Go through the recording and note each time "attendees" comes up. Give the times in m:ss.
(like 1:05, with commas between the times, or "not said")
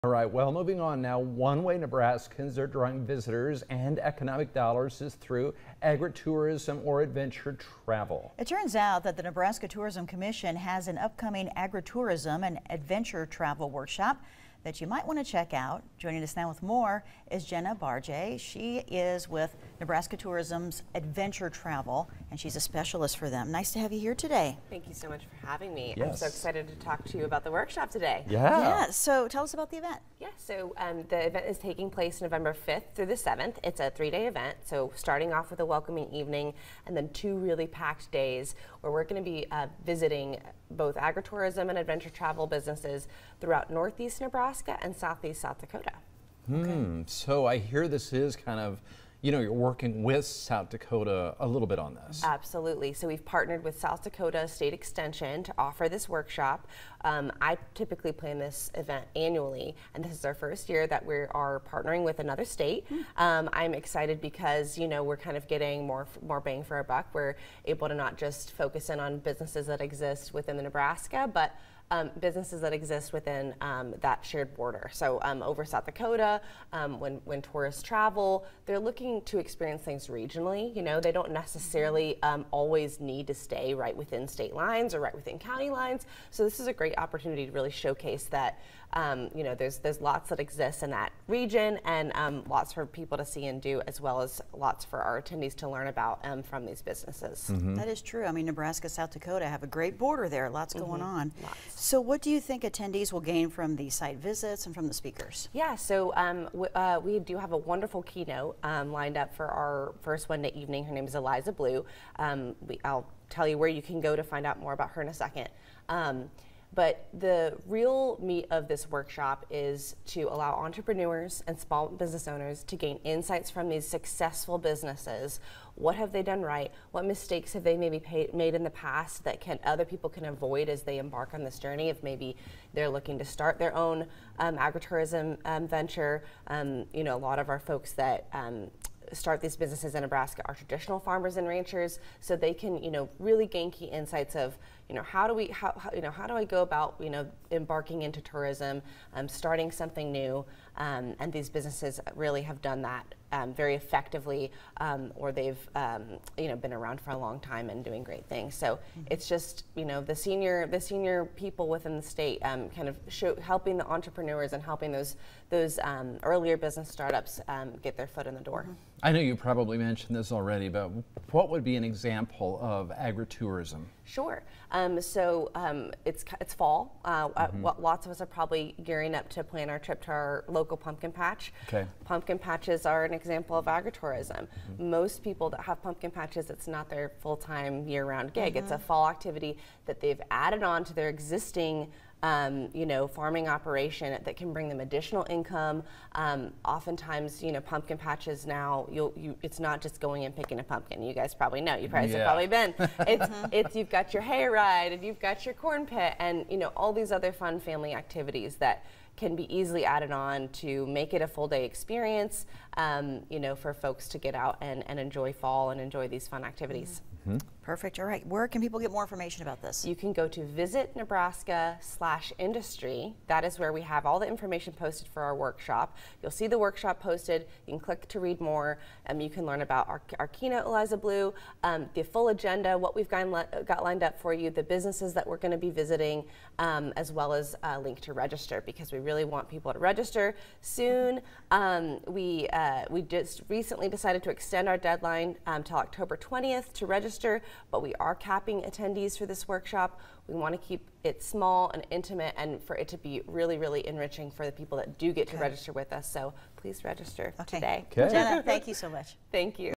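1:35, 1:42, 4:08.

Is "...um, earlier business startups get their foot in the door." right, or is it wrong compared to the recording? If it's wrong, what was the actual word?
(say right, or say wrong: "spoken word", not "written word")
right.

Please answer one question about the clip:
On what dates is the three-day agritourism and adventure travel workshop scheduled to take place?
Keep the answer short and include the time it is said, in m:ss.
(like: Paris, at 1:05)
November 5-7, at 0:32.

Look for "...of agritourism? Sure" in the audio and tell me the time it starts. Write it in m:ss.
2:52.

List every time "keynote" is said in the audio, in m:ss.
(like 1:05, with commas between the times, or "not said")
1:48, 3:50.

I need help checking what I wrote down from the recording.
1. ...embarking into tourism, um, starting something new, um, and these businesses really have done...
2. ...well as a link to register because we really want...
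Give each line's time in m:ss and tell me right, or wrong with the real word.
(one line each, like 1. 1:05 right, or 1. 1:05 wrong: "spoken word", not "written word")
1. 2:27 right
2. 3:57 right.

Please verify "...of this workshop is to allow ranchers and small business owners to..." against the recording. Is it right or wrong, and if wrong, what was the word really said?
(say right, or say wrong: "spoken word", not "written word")
wrong: "entrepreneurs", not "ranchers".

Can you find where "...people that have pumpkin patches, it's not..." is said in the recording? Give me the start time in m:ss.
3:05.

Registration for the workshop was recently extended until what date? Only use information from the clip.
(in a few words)
October 20.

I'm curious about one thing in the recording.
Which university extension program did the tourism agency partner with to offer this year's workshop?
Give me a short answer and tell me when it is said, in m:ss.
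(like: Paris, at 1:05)
South Dakota State Extension, at 0:53.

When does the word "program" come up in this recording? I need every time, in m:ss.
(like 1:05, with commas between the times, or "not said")
not said.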